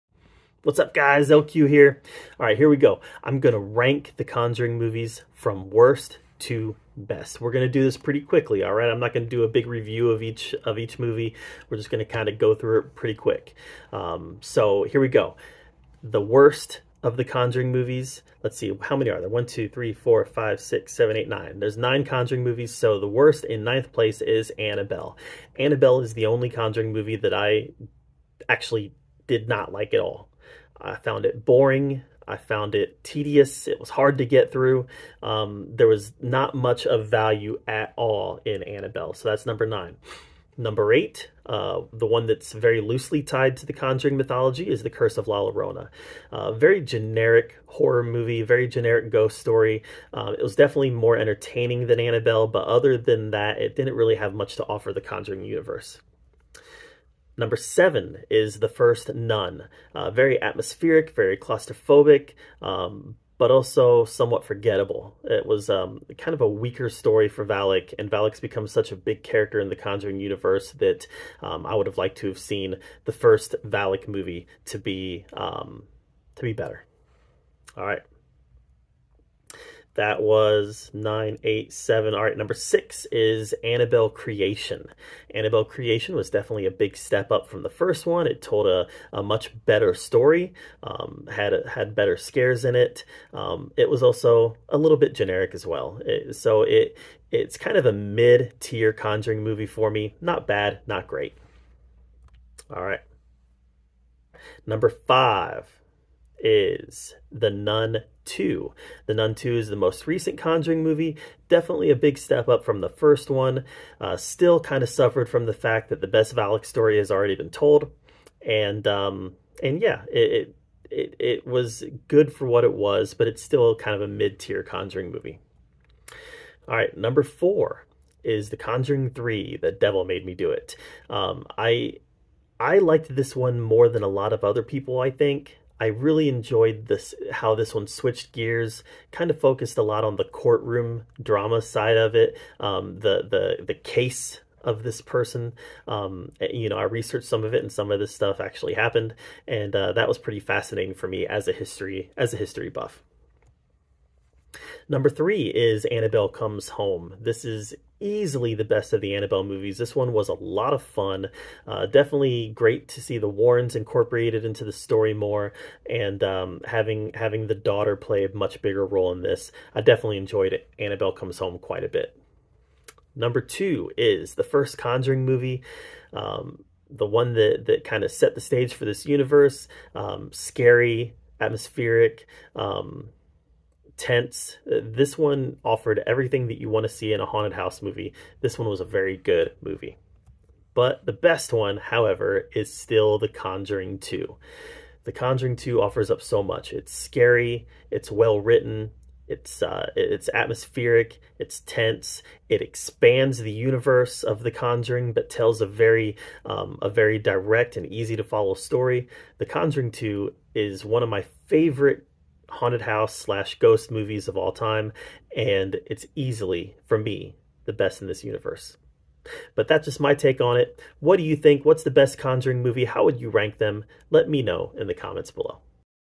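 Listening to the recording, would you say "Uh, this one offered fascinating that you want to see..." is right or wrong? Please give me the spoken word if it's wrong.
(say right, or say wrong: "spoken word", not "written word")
wrong: "everything", not "fascinating".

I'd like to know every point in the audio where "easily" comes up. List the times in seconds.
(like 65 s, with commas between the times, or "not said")
157 s, 216 s.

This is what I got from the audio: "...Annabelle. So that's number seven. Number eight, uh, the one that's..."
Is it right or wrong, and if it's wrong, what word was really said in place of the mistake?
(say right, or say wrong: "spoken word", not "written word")
wrong: "nine", not "seven".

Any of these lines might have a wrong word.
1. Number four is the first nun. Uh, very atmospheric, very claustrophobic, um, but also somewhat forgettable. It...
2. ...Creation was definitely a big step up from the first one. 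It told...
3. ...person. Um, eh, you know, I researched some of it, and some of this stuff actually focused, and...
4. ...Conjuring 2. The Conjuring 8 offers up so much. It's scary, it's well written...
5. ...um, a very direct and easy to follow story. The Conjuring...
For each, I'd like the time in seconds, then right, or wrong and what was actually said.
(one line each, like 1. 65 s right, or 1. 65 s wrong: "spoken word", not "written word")
1. 57 s wrong: "seven", not "four"
2. 85 s right
3. 145 s wrong: "happened", not "focused"
4. 193 s wrong: "2", not "8"
5. 206 s right.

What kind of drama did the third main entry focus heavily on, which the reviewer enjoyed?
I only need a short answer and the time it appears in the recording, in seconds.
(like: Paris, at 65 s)
Courtroom drama, at 140 s.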